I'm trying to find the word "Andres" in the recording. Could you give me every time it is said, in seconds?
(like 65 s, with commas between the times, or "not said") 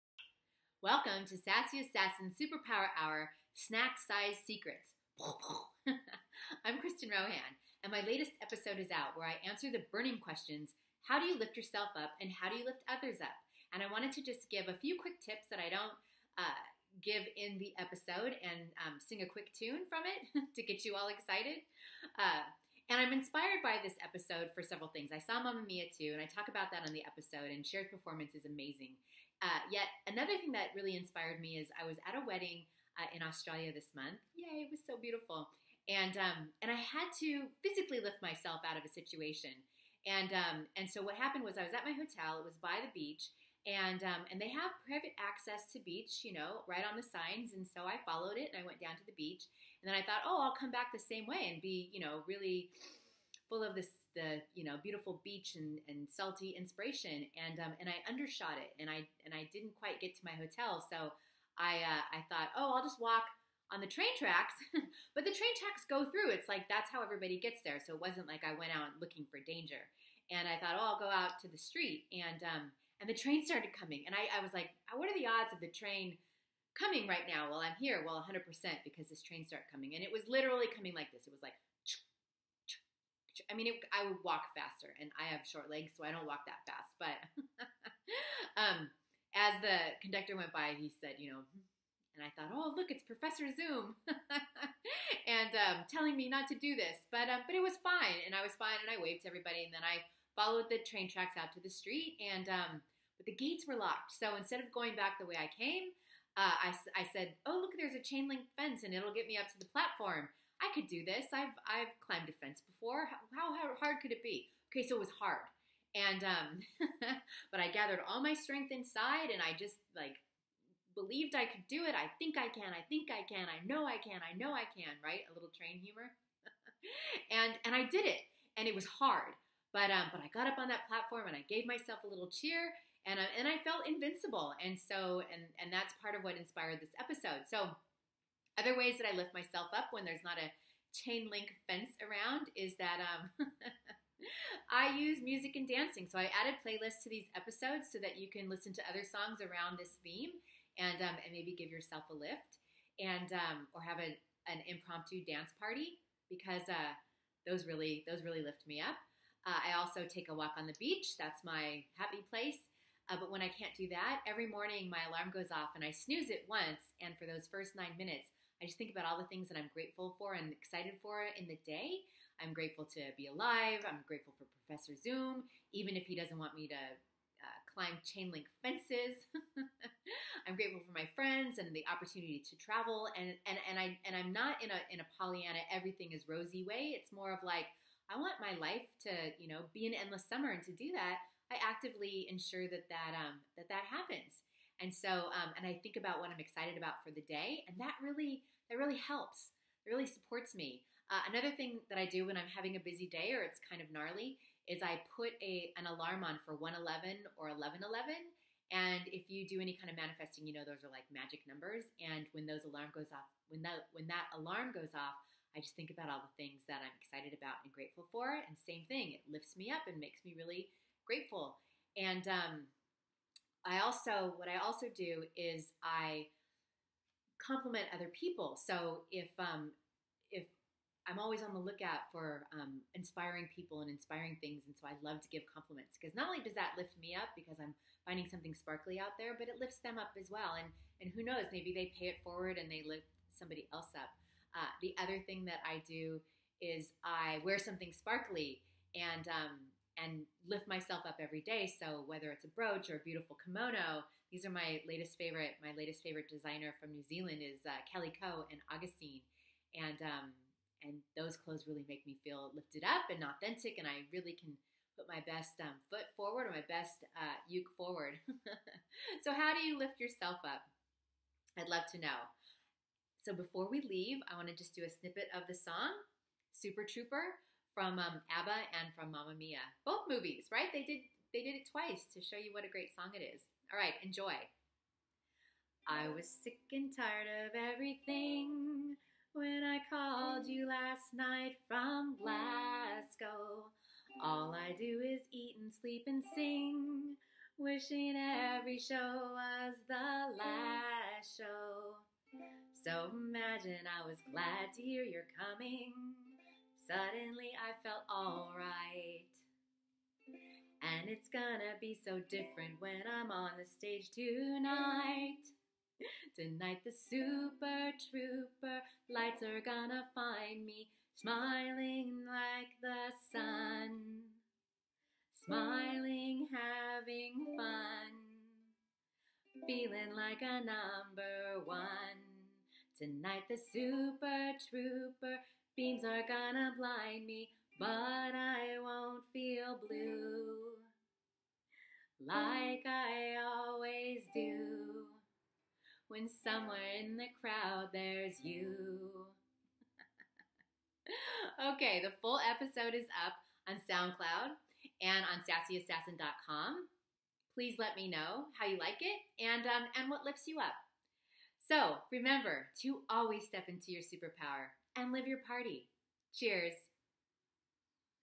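not said.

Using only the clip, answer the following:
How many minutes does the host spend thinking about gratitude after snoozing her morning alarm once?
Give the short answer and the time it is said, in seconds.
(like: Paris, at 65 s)
9, at 167 s.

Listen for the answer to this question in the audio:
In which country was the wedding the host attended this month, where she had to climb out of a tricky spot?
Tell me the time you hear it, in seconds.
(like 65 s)
33 s.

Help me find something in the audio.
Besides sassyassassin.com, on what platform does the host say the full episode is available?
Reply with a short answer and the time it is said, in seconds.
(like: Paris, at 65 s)
SoundCloud, at 353 s.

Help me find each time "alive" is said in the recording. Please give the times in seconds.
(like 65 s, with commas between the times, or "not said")
173 s.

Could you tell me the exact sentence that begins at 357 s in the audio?
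Please let me know how you like it and um, and what lifts you up.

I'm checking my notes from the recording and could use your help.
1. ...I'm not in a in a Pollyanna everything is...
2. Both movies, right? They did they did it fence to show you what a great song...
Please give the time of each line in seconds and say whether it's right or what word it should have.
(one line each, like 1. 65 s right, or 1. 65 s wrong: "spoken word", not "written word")
1. 184 s right
2. 279 s wrong: "twice", not "fence".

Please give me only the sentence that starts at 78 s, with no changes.
Well, 100% because this train started coming, and it was literally coming like this.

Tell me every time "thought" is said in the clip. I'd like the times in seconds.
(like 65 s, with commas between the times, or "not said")
50 s, 62 s, 70 s, 92 s.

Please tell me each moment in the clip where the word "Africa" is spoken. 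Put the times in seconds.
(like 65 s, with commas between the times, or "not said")
not said.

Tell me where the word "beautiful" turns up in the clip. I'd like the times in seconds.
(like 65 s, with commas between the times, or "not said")
34 s, 54 s, 253 s.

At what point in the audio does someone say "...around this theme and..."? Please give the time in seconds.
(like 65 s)
149 s.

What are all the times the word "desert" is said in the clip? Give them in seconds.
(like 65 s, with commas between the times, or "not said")
not said.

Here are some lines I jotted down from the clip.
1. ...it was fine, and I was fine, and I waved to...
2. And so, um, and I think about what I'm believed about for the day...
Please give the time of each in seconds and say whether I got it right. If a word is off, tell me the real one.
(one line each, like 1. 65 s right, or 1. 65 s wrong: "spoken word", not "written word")
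1. 97 s right
2. 194 s wrong: "excited", not "believed".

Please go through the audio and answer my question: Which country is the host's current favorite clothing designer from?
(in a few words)
New Zealand.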